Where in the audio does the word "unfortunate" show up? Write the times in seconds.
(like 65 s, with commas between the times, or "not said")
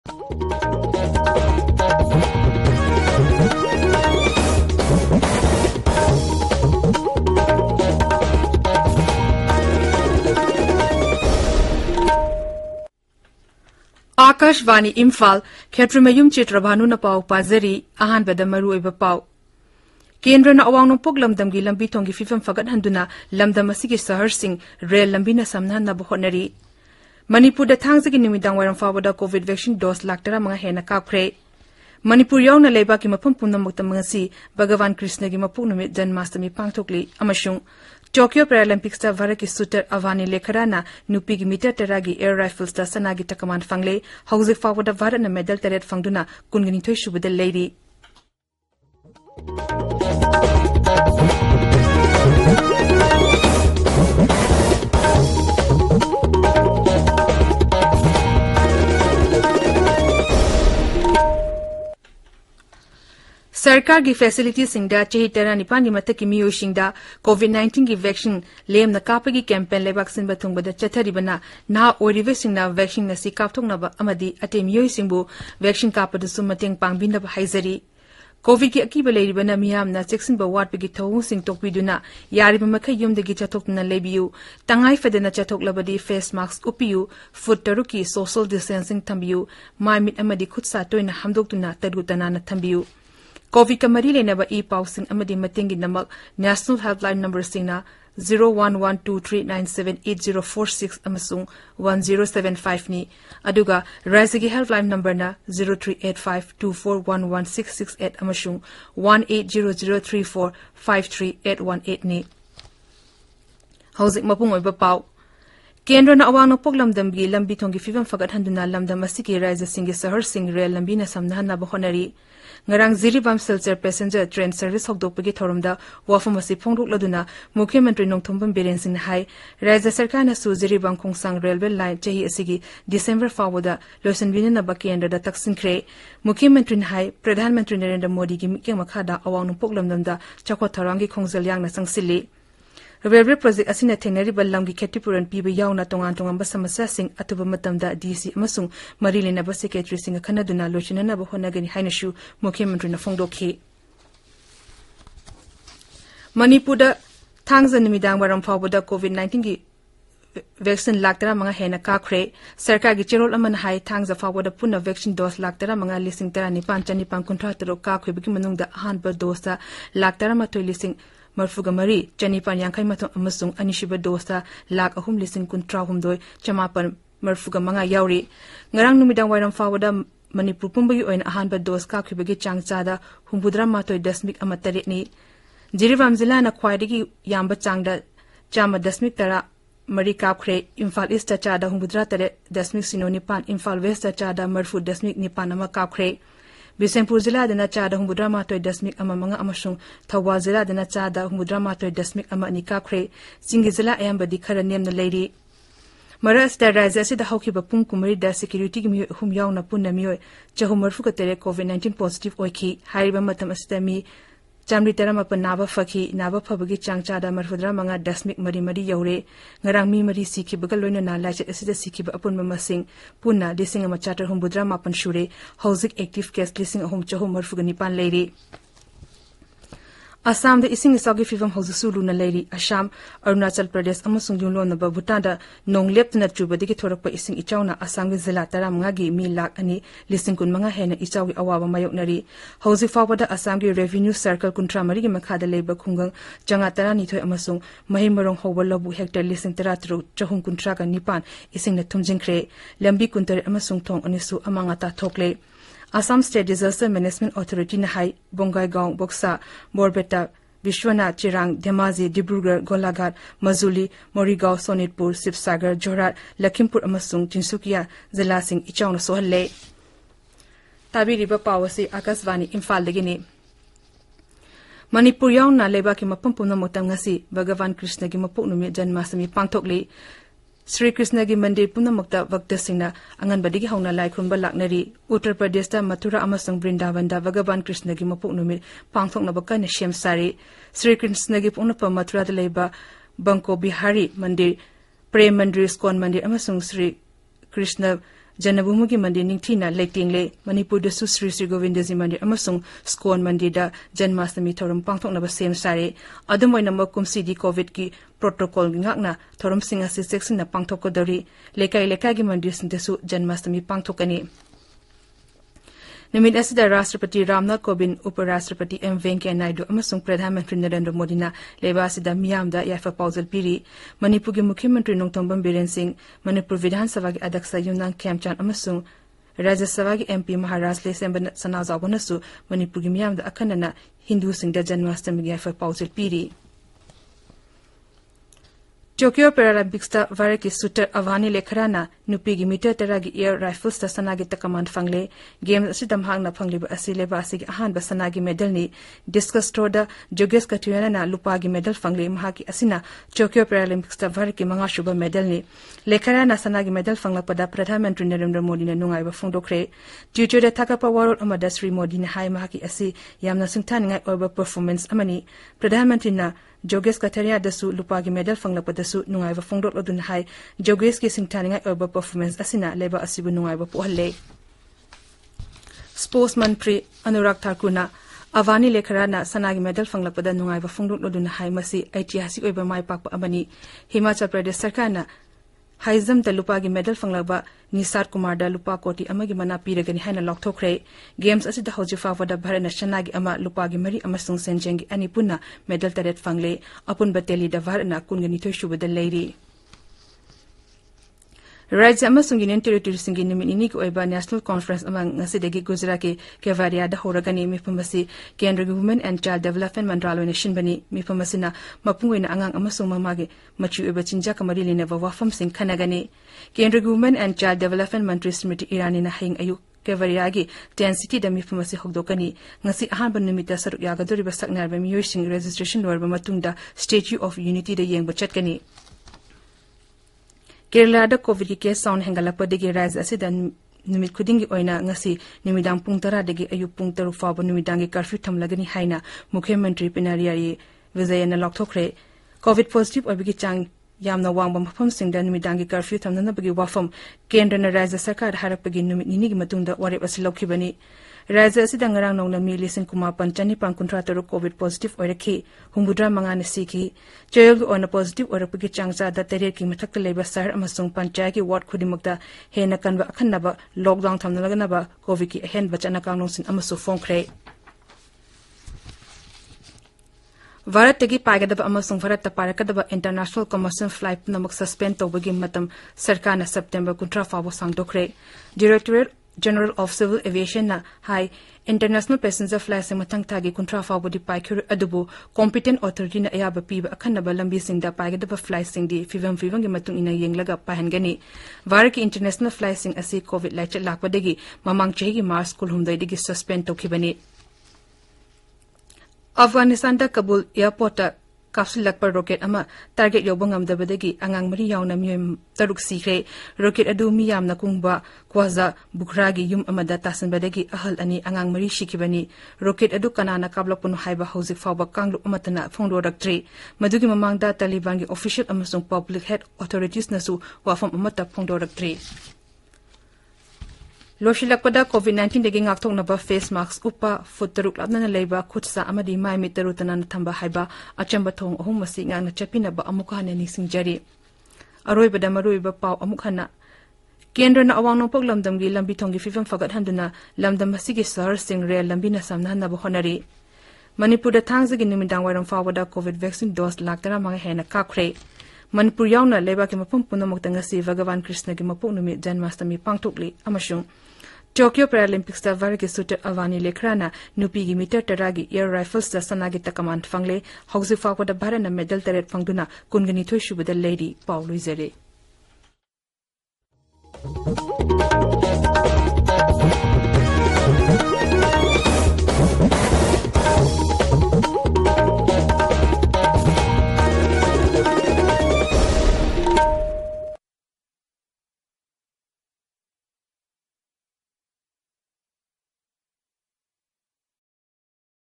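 not said.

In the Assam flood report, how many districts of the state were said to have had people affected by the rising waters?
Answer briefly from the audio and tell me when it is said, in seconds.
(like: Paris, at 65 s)
Kuntra Manga (25), at 240 s.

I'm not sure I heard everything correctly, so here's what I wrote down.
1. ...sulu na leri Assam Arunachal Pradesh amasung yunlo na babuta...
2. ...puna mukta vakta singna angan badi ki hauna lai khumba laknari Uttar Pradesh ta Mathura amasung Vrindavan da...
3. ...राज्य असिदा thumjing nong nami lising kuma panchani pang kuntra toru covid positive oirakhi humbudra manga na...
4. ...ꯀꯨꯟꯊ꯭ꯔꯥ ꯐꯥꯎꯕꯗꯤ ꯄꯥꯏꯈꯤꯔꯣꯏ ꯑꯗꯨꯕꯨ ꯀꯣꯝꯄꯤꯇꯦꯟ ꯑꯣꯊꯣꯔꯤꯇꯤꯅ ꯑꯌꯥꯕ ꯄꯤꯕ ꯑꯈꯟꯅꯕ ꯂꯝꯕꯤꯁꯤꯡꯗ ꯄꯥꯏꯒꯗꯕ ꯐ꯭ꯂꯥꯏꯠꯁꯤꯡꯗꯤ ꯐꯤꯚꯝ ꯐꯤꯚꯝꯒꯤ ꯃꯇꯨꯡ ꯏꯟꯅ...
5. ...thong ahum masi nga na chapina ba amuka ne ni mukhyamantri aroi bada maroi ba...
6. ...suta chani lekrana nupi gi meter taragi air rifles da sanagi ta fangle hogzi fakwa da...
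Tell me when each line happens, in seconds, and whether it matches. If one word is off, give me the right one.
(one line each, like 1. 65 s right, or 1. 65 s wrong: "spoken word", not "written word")
1. 231 s right
2. 281 s right
3. 451 s wrong: "ngarang", not "thumjing"
4. 483 s right
5. 531 s wrong: "singjari", not "mukhyamantri"
6. 555 s wrong: "avani", not "chani".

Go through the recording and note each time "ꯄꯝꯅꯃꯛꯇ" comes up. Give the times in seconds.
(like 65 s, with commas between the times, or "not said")
33 s, 276 s.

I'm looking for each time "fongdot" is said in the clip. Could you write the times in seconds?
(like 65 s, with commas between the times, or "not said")
369 s, 380 s.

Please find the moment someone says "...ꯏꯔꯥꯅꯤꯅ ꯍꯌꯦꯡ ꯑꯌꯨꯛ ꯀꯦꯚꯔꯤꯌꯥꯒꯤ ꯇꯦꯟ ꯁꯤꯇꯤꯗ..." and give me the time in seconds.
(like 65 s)
418 s.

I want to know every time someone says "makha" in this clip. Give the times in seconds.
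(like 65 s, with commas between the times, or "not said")
138 s, 245 s.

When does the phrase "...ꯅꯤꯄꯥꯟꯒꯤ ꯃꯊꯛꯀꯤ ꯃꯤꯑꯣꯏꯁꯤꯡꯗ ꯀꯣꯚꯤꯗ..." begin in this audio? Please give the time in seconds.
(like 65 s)
65 s.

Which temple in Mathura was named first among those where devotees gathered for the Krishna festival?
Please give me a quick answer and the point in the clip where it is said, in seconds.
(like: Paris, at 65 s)
Banke Bihari mandir, at 293 s.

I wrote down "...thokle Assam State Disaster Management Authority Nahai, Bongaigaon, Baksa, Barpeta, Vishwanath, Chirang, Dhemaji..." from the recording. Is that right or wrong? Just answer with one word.
right.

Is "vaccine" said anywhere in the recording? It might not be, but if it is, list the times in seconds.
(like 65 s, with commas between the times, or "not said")
160 s, 164 s.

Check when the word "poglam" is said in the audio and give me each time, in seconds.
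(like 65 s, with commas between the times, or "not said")
116 s, 139 s.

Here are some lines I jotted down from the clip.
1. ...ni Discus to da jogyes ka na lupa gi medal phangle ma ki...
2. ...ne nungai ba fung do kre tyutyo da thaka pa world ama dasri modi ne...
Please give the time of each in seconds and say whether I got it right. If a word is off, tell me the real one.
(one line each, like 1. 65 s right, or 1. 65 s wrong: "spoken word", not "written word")
1. 348 s right
2. 358 s right.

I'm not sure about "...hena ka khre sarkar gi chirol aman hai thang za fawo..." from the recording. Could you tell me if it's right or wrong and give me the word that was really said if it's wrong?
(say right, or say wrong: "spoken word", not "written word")
right.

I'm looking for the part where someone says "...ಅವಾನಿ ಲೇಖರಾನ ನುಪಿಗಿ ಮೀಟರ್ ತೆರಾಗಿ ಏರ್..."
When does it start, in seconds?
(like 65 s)
39 s.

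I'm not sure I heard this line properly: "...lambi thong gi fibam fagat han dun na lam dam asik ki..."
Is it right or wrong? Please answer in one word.
right.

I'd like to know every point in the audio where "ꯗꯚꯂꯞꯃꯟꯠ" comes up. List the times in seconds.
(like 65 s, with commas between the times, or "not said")
409 s, 417 s.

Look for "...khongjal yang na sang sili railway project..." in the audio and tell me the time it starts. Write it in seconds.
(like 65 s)
141 s.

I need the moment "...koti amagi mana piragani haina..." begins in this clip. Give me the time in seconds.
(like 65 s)
388 s.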